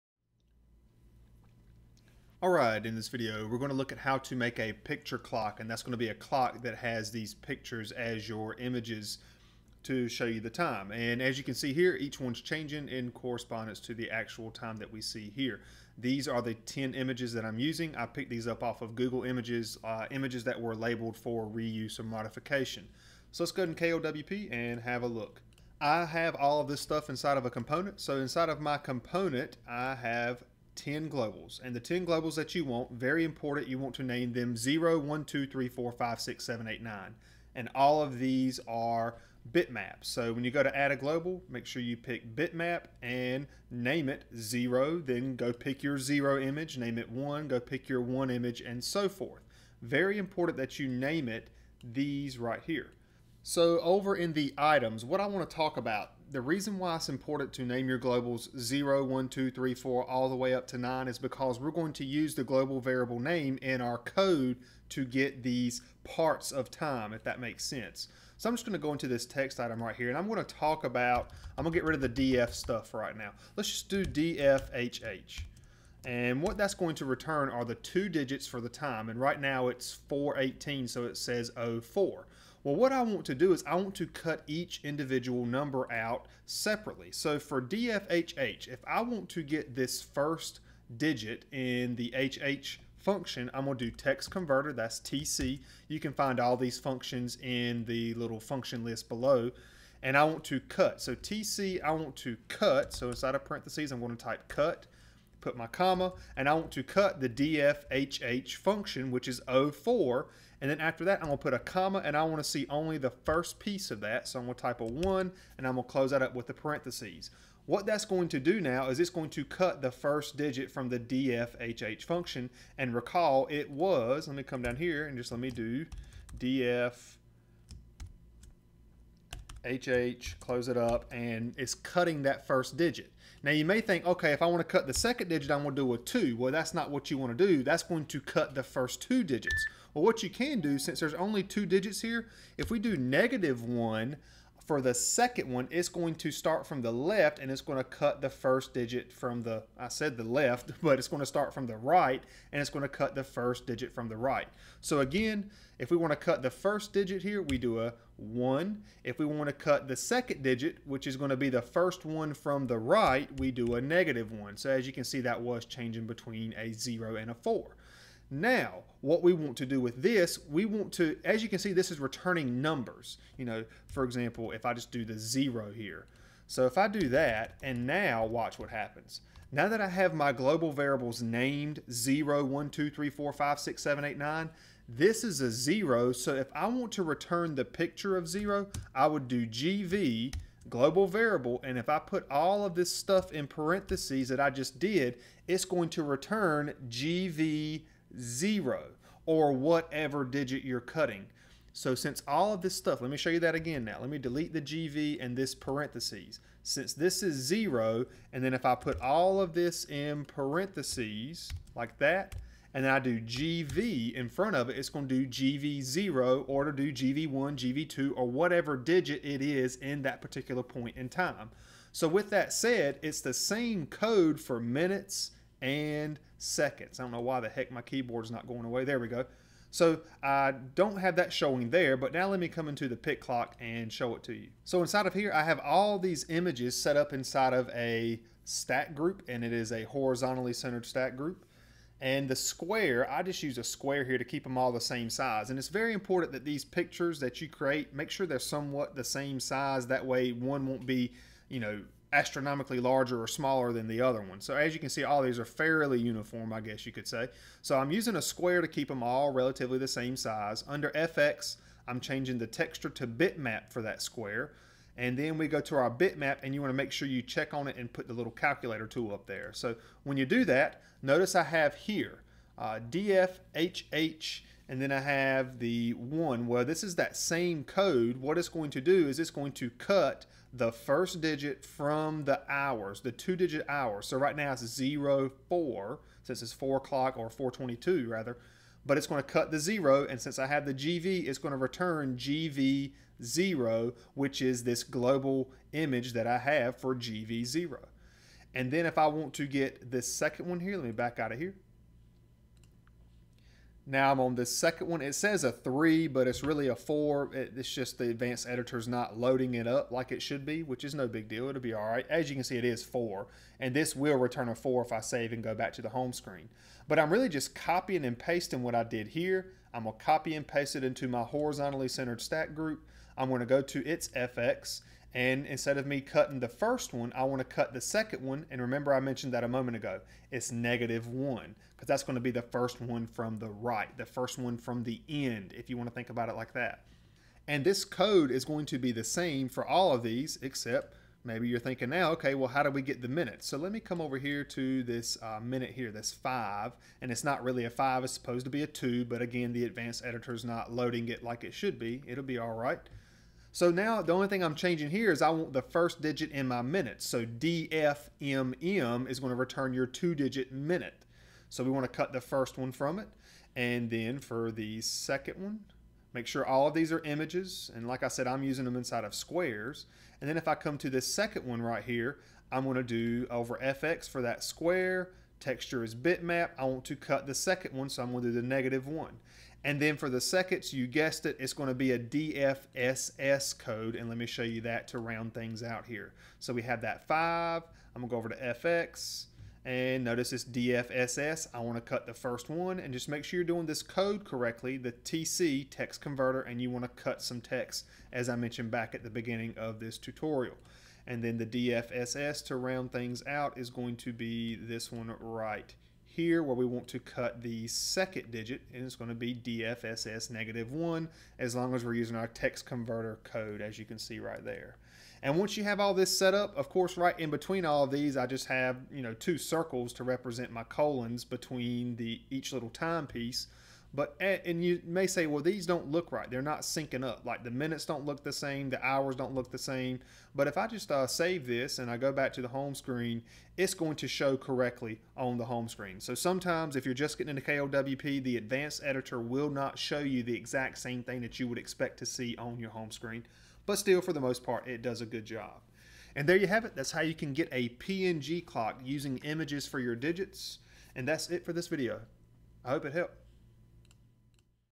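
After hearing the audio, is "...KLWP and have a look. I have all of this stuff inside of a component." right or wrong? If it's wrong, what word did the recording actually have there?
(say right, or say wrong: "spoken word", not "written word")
right.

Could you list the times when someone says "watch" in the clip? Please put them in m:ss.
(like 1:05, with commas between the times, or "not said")
2:58.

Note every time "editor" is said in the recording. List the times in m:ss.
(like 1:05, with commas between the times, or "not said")
5:08, 5:50, 7:18.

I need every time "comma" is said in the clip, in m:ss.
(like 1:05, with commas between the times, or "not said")
1:45, 1:51.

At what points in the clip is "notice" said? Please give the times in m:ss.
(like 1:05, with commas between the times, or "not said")
4:31, 6:30.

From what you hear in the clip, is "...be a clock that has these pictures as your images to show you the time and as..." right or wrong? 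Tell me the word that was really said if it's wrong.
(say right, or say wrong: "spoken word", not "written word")
right.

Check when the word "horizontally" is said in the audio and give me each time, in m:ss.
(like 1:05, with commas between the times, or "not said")
3:59, 5:21.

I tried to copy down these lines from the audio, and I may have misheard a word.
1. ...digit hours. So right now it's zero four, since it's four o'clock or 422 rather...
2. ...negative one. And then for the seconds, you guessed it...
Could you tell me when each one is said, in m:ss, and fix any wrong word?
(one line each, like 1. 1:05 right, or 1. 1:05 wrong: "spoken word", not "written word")
1. 4:43 right
2. 6:18 right.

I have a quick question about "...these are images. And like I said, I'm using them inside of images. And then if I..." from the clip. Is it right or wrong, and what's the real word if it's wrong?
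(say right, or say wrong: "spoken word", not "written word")
wrong: "squares", not "images".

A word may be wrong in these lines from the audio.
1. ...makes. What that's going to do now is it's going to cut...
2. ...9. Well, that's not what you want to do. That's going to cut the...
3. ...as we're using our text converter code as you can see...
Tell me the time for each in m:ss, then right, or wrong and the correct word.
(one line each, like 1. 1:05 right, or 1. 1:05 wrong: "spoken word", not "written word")
1. 1:56 wrong: "parentheses", not "makes"
2. 2:15 wrong: "2", not "9"
3. 6:51 right.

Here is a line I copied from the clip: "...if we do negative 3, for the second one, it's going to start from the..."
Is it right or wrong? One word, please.
wrong.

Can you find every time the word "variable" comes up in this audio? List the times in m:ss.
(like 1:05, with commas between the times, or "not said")
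1:02, 3:00, 3:11.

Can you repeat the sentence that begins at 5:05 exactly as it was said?
It says a three, but it's really a four.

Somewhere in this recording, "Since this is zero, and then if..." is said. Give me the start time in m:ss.
3:26.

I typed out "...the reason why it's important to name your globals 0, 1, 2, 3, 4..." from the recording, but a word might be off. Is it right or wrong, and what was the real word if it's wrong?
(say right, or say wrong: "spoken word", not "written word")
right.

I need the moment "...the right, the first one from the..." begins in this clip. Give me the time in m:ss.
5:33.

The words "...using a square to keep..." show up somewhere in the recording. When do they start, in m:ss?
4:17.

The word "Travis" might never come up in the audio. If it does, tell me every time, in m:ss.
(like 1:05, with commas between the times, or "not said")
not said.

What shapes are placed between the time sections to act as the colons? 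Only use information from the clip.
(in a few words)
two circles.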